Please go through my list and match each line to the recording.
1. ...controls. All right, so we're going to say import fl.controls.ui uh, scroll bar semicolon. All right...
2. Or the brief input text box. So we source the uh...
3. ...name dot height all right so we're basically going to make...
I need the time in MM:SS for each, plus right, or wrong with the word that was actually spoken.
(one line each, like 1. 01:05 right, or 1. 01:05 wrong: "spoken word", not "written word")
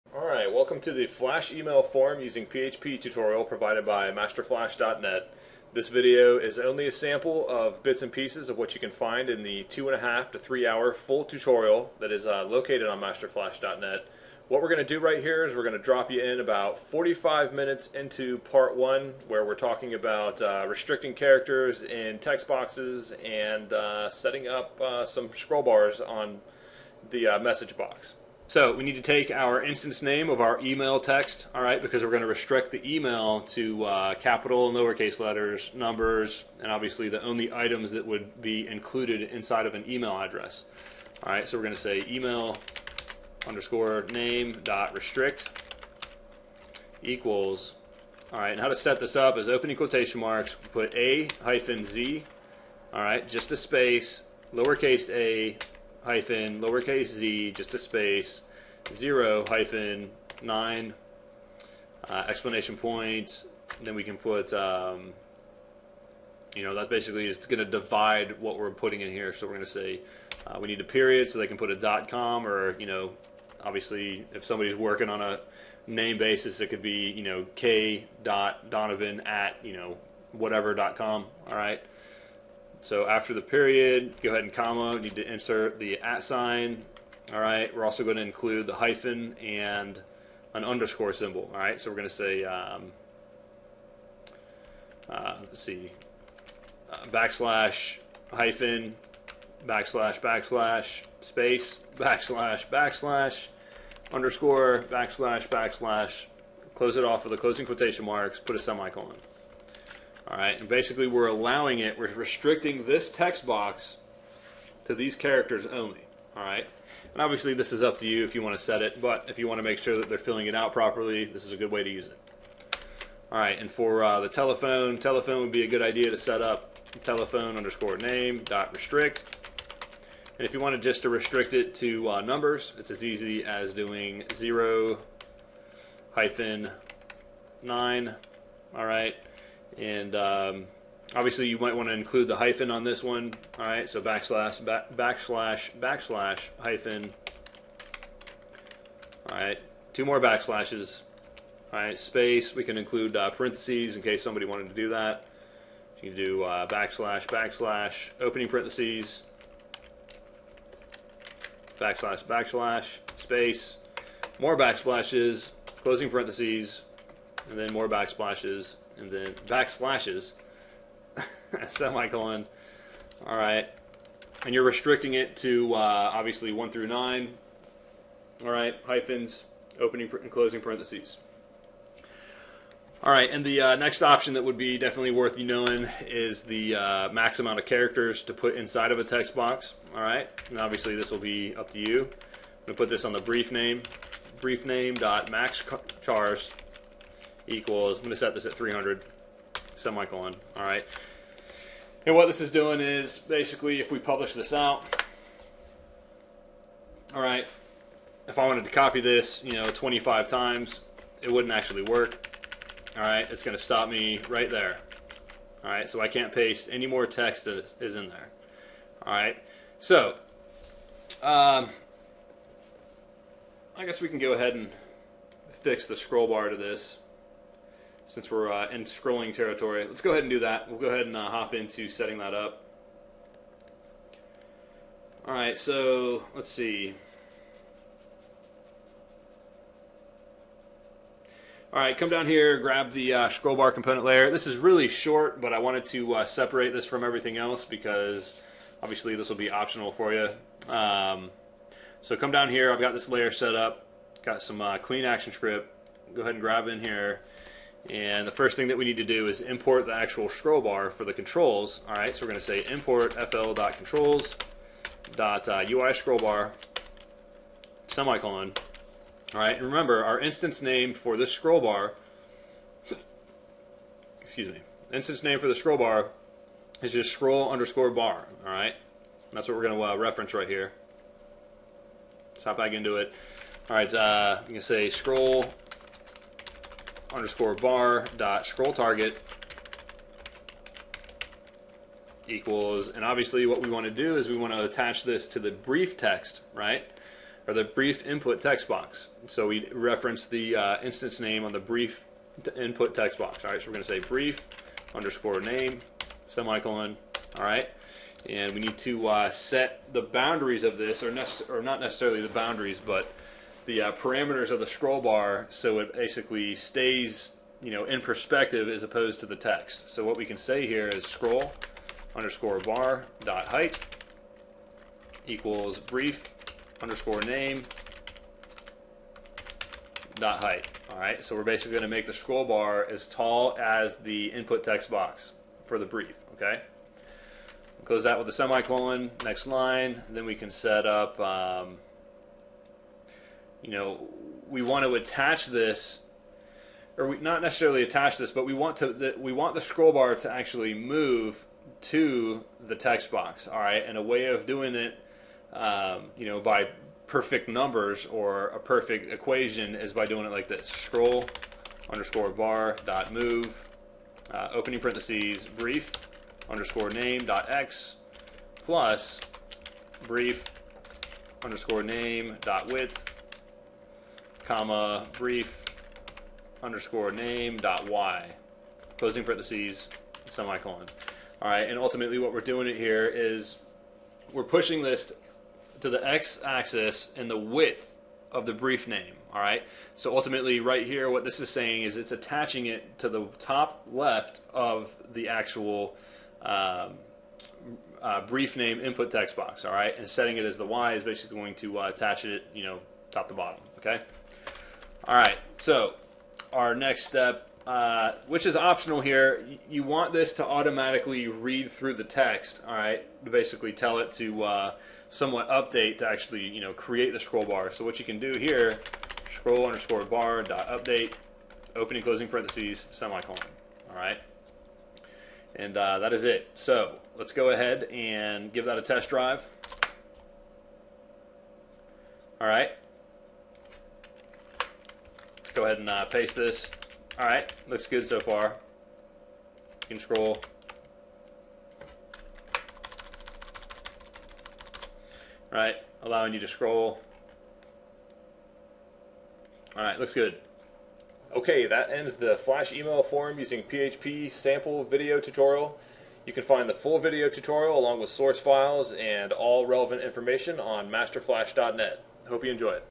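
1. 04:21 right
2. 04:57 wrong: "reference", not "source"
3. 05:27 right.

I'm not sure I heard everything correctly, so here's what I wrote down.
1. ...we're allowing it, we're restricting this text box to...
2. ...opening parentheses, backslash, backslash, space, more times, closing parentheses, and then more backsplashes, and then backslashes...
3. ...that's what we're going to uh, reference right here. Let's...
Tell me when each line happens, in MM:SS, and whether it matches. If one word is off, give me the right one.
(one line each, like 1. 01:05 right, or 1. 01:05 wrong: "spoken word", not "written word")
1. 01:51 right
2. 02:38 wrong: "backsplashes", not "times"
3. 04:39 right.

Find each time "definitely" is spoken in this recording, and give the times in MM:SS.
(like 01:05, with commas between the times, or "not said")
03:04.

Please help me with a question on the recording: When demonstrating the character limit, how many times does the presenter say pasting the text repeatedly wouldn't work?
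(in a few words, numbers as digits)
25.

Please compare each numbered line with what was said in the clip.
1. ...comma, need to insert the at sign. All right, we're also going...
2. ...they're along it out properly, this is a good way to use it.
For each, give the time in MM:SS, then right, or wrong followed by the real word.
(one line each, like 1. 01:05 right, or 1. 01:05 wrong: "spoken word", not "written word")
1. 01:24 right
2. 02:00 wrong: "filling", not "along".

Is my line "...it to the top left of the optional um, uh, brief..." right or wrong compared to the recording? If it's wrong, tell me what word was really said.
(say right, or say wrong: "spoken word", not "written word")
wrong: "actual", not "optional".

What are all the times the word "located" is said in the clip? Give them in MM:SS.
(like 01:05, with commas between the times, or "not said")
00:12.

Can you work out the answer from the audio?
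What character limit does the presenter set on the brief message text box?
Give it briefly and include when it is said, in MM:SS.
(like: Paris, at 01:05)
300, at 03:18.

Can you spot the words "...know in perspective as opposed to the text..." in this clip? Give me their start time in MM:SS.
05:17.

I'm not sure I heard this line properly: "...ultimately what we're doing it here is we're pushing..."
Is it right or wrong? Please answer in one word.
right.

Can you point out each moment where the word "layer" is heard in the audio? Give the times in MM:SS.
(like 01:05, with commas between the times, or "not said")
04:04, 04:13.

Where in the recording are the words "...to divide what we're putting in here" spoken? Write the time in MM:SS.
01:07.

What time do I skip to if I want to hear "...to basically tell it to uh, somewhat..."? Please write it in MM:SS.
06:53.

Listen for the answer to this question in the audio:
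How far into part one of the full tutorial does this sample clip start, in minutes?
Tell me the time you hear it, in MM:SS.
00:16.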